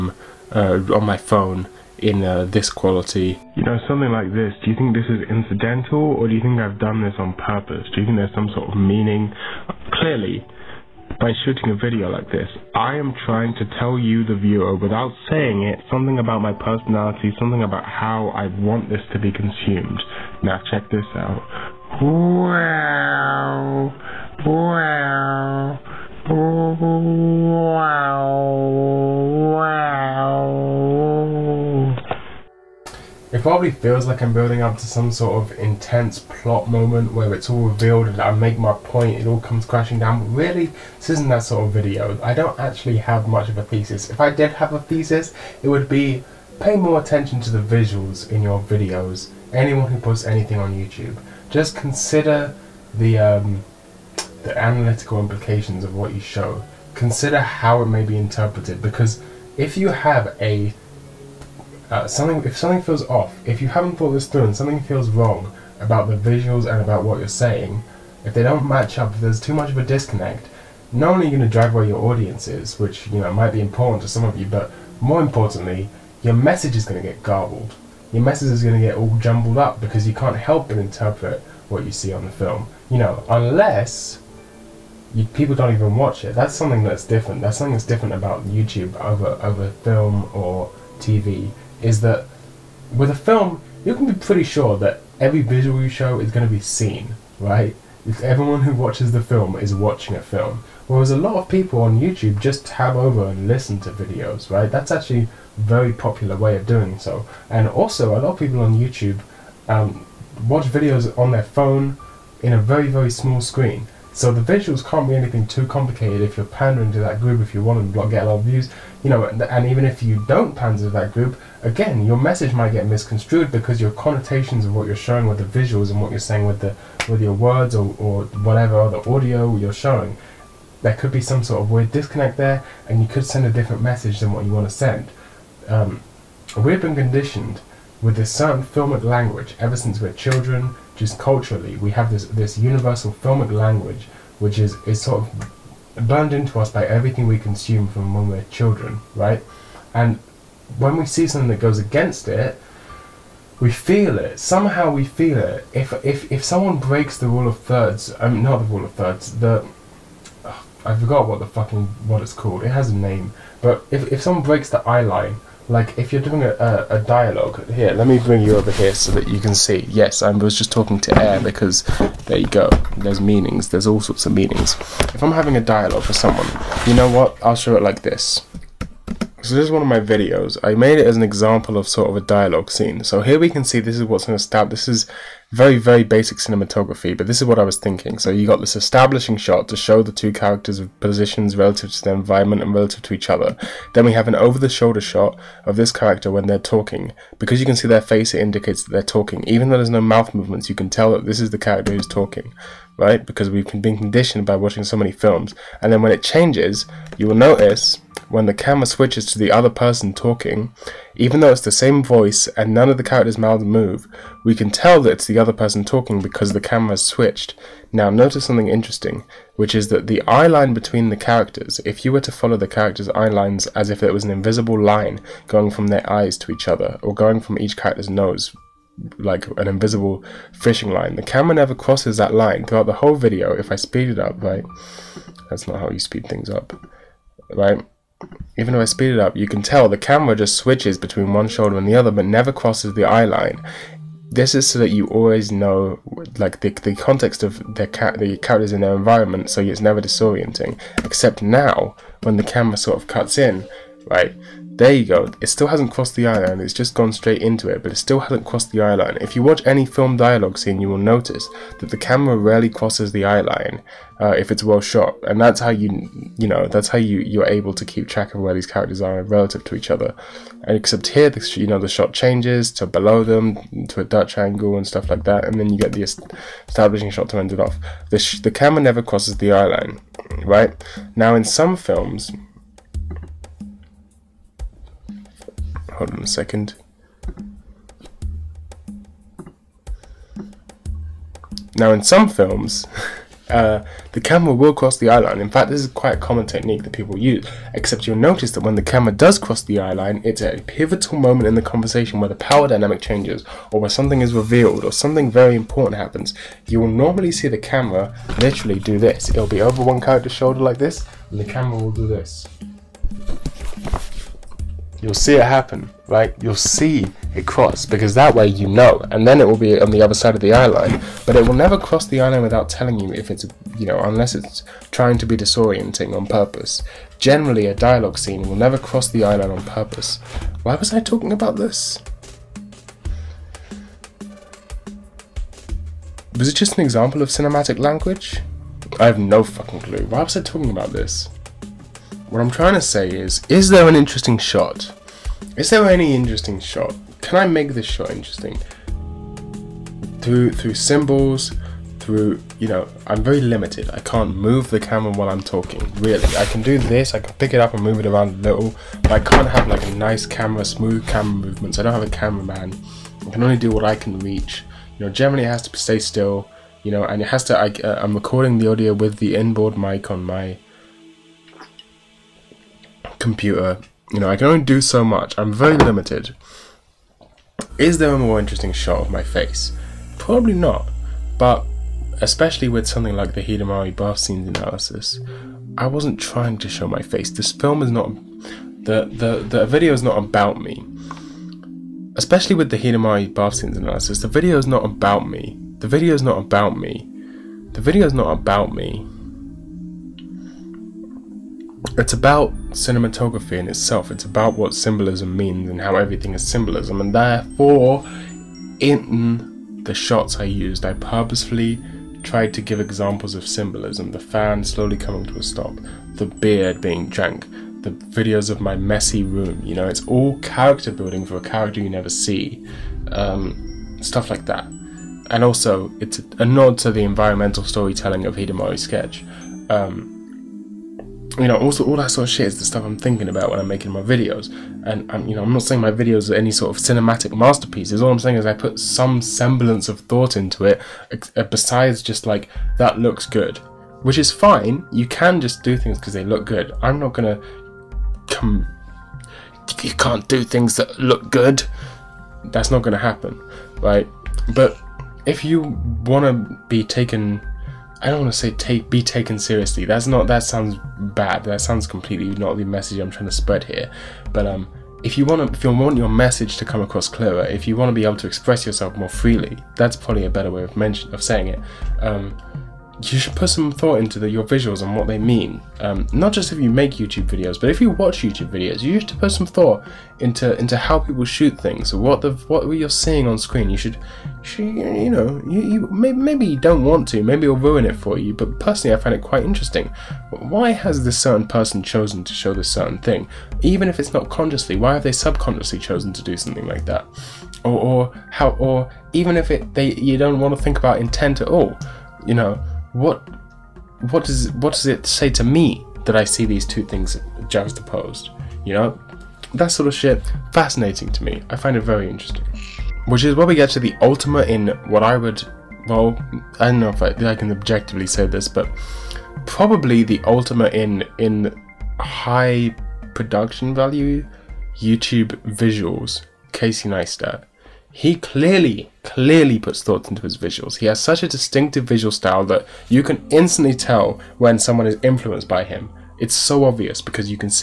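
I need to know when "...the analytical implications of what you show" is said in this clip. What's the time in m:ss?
0:54.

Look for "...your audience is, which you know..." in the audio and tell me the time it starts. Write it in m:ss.
1:11.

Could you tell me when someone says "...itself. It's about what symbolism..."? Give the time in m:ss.
6:43.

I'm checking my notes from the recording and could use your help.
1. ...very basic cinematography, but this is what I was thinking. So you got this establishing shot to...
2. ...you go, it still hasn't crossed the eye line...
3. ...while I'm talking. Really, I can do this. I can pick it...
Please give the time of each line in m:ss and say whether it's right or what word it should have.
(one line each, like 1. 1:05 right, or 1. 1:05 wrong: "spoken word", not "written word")
1. 3:05 right
2. 4:14 right
3. 5:55 right.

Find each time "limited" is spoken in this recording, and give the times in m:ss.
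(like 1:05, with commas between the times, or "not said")
5:53, 6:15.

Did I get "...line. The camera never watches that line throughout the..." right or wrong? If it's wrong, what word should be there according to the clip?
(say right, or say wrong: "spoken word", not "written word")
wrong: "crosses", not "watches".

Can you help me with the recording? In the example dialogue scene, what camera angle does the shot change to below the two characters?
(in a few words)
Dutch angle.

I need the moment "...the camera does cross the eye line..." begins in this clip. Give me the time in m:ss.
4:58.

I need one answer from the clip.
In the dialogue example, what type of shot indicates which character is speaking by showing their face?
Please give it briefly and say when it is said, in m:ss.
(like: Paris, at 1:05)
over-the-shoulder shot, at 3:14.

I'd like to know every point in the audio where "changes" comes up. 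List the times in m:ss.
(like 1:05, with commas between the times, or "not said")
3:26, 4:32, 5:03.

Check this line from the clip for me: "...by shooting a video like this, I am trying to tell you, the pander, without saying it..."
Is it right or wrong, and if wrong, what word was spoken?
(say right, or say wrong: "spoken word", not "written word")
wrong: "viewer", not "pander".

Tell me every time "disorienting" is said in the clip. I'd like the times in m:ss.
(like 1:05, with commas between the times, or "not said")
4:10, 5:25.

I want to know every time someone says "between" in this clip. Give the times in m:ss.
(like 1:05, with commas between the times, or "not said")
3:40, 4:00.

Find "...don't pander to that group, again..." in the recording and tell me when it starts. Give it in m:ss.
2:00.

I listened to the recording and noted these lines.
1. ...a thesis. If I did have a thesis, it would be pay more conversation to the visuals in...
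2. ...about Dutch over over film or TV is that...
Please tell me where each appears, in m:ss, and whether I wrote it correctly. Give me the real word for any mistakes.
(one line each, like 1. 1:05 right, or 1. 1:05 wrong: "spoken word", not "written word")
1. 0:43 wrong: "attention", not "conversation"
2. 1:28 wrong: "YouTube", not "Dutch".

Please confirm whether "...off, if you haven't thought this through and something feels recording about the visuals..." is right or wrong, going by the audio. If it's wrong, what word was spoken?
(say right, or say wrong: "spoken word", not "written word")
wrong: "wrong", not "recording".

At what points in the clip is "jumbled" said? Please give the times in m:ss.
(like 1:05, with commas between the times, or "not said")
1:19.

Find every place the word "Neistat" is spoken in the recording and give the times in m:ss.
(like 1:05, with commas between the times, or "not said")
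8:46.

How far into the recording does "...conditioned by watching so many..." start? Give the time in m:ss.
3:23.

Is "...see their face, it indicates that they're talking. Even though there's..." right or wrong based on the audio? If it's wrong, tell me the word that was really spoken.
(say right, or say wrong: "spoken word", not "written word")
right.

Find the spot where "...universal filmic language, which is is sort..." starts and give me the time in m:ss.
2:22.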